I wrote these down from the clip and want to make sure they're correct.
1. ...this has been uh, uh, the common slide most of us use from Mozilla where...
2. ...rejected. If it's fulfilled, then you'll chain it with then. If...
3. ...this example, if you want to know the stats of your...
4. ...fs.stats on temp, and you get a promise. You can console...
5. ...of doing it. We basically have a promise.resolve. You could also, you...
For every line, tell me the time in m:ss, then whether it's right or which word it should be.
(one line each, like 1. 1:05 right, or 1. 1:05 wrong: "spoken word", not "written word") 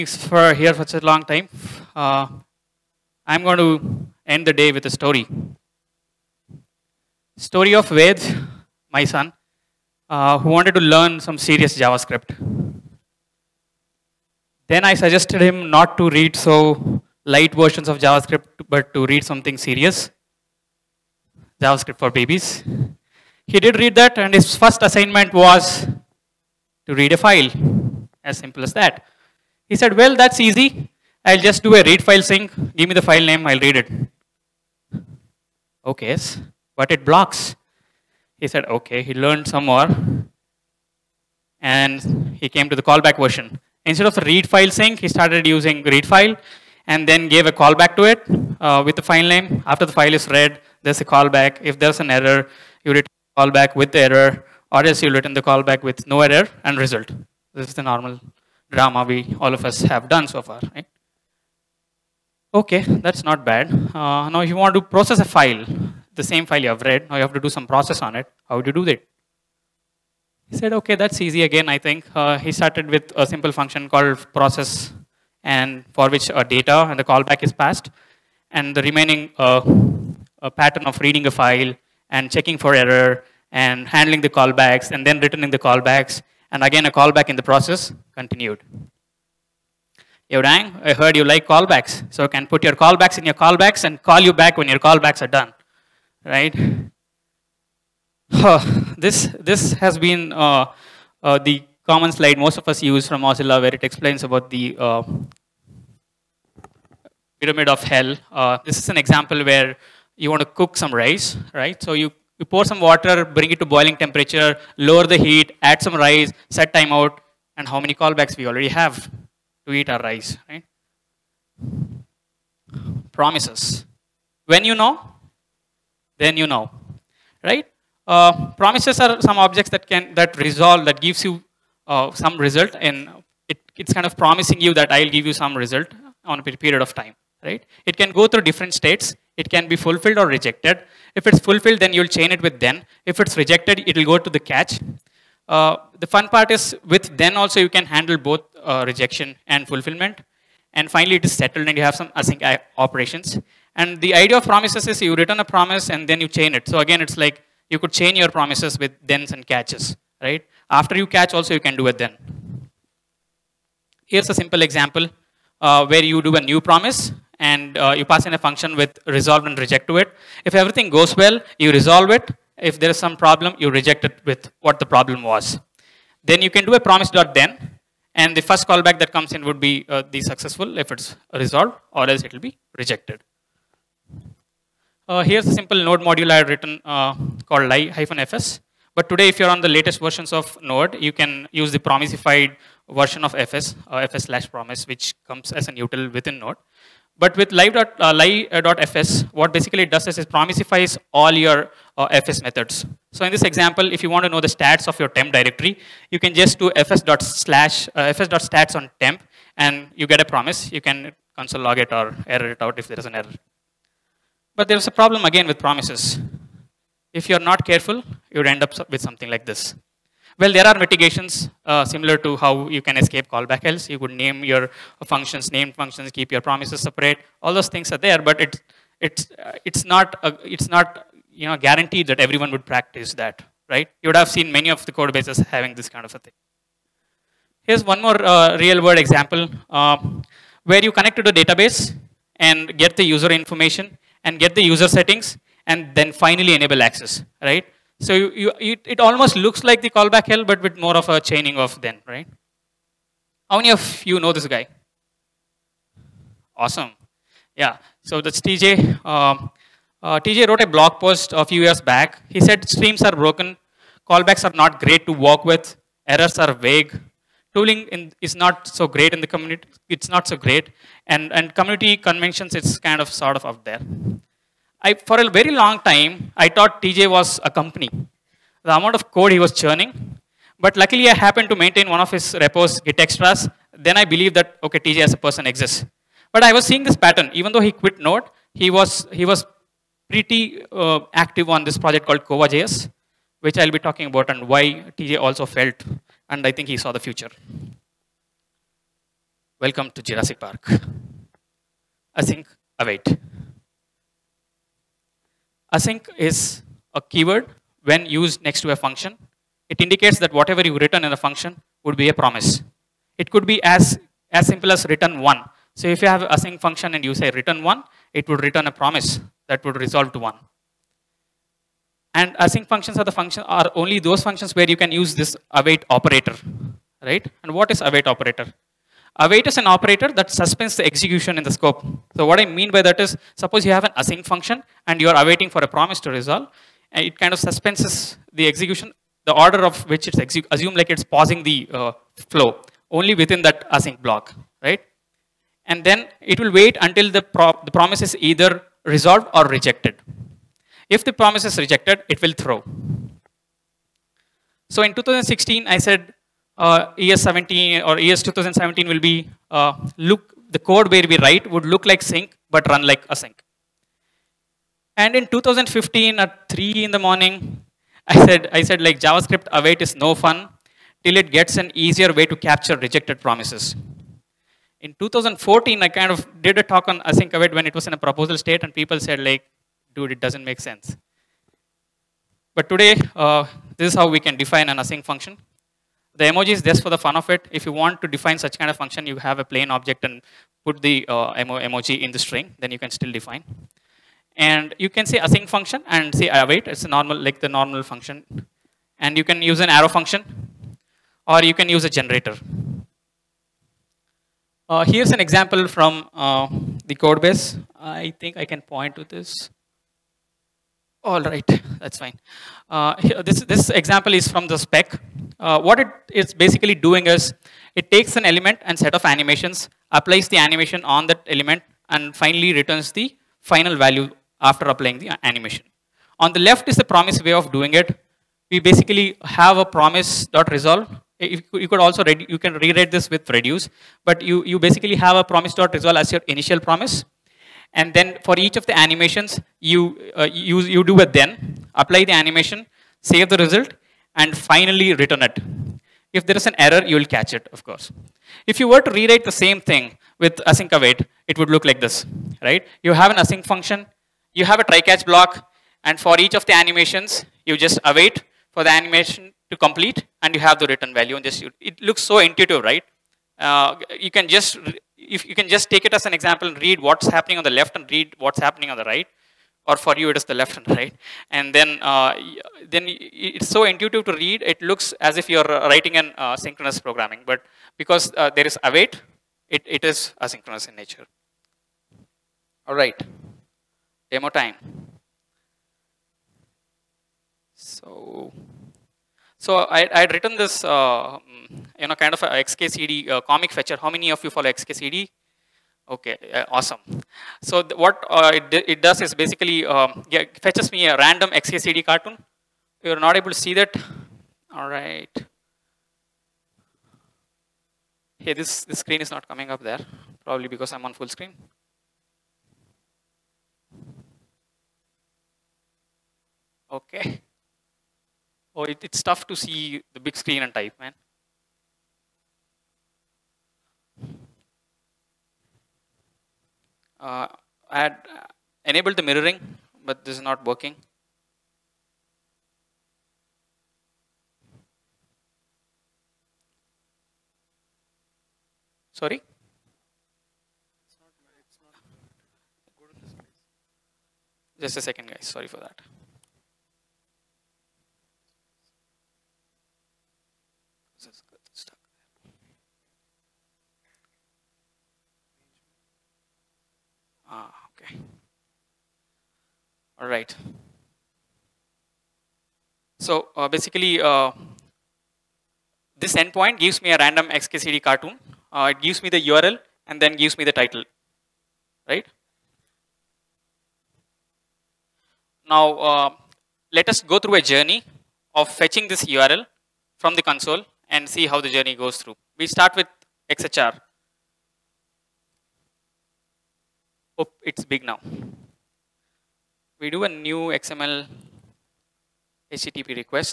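1. 1:39 right
2. 2:20 right
3. 3:23 right
4. 3:28 right
5. 7:07 right.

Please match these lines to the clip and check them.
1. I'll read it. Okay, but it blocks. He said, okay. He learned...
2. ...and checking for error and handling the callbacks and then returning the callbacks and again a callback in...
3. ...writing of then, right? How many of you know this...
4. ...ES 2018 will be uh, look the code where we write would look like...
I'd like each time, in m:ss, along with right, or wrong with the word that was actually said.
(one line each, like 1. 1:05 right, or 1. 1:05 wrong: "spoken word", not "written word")
1. 0:33 right
2. 1:22 right
3. 4:11 wrong: "chaining", not "writing"
4. 5:57 wrong: "2017", not "2018".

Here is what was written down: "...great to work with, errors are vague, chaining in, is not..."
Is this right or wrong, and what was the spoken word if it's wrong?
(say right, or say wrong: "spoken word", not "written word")
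wrong: "tooling", not "chaining".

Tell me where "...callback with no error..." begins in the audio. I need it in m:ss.
0:55.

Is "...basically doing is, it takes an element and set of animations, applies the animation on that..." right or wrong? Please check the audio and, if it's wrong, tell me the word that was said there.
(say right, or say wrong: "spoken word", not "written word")
right.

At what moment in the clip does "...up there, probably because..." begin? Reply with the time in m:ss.
8:29.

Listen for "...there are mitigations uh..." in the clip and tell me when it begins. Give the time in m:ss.
3:40.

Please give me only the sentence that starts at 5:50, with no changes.
If the promise is rejected, it will throw.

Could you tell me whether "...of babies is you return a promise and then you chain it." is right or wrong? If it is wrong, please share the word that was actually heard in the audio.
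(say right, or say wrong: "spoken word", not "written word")
wrong: "promises", not "babies".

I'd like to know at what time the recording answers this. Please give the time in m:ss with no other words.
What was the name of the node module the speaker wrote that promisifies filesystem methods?
3:07.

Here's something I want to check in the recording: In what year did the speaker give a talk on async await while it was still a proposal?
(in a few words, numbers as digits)
2014.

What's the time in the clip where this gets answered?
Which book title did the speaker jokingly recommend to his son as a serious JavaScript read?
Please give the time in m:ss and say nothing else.
0:21.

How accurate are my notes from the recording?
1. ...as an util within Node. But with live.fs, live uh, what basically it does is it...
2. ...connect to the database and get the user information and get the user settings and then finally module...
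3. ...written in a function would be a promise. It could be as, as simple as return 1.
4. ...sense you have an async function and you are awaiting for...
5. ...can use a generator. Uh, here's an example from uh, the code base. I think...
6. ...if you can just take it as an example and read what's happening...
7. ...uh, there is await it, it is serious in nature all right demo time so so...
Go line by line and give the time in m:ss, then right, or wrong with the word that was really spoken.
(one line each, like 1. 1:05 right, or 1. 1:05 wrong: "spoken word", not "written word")
1. 3:15 right
2. 4:00 wrong: "enable", not "module"
3. 5:10 right
4. 5:33 wrong: "suppose", not "sense"
5. 6:41 right
6. 7:44 right
7. 7:58 wrong: "asynchronous", not "serious".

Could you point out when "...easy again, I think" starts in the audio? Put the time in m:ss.
1:11.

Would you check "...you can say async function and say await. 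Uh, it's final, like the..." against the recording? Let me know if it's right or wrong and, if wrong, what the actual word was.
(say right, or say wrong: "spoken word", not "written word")
wrong: "normal", not "final".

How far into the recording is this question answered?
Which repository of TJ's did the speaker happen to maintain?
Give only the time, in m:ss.
4:42.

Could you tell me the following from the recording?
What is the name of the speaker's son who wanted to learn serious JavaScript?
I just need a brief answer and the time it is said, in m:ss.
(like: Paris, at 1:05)
Ved, at 0:07.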